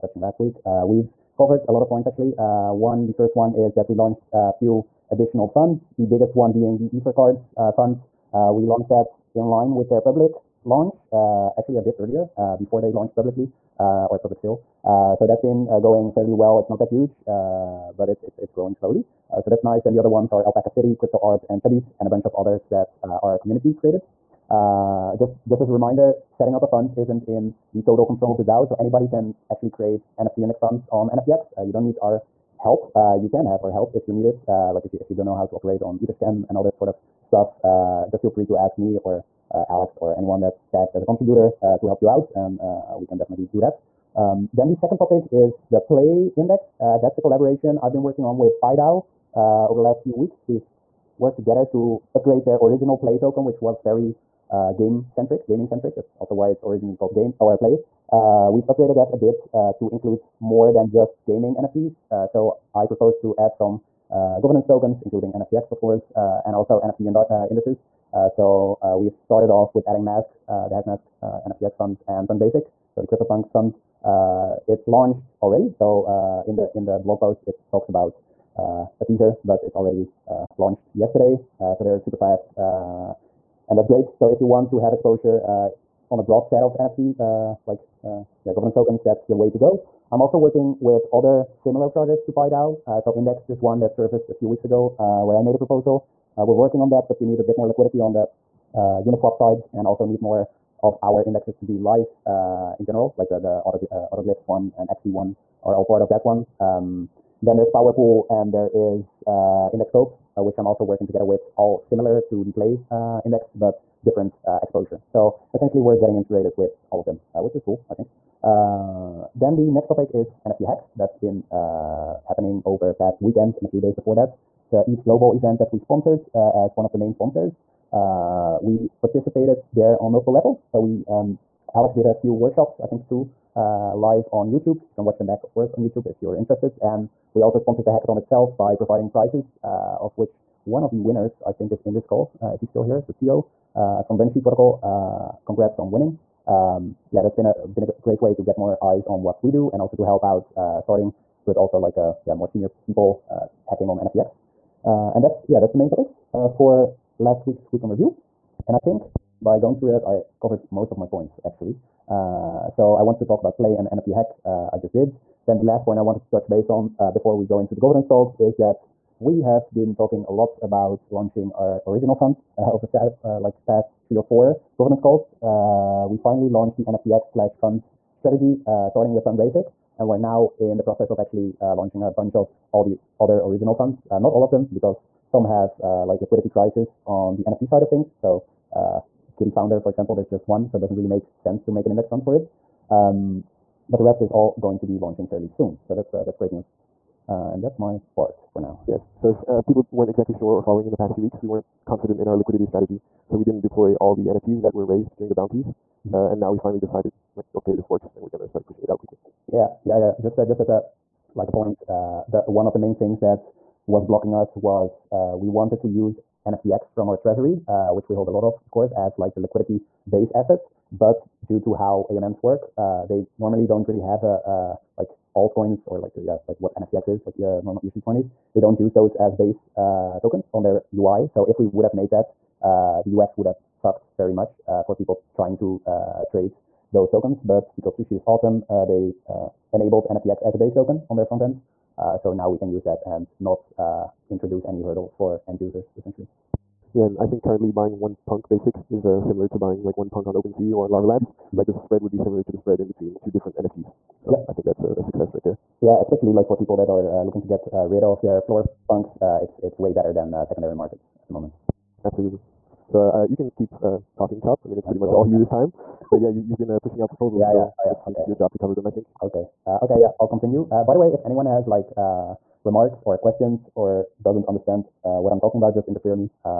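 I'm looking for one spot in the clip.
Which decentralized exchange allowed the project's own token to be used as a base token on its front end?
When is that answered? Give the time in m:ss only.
3:57.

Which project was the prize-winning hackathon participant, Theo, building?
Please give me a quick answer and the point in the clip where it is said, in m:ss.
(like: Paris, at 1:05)
Banshee Protocol, at 2:24.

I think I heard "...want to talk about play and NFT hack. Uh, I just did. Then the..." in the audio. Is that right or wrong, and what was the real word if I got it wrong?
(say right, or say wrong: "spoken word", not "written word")
right.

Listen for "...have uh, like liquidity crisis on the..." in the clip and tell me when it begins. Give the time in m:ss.
3:05.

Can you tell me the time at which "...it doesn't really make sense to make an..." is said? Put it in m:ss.
3:10.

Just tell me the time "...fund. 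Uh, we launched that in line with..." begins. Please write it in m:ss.
0:07.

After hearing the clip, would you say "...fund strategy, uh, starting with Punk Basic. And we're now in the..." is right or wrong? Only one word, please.
right.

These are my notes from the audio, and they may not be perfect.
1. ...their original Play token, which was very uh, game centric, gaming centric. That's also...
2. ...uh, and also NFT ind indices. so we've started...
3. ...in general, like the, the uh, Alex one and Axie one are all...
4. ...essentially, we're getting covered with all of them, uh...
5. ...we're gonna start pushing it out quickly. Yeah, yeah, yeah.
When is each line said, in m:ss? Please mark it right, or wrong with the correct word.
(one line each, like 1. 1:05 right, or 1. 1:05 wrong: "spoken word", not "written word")
1. 0:52 right
2. 1:06 right
3. 1:42 wrong: "Autoglyphs", not "Alex"
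4. 1:55 wrong: "integrated", not "covered"
5. 3:28 right.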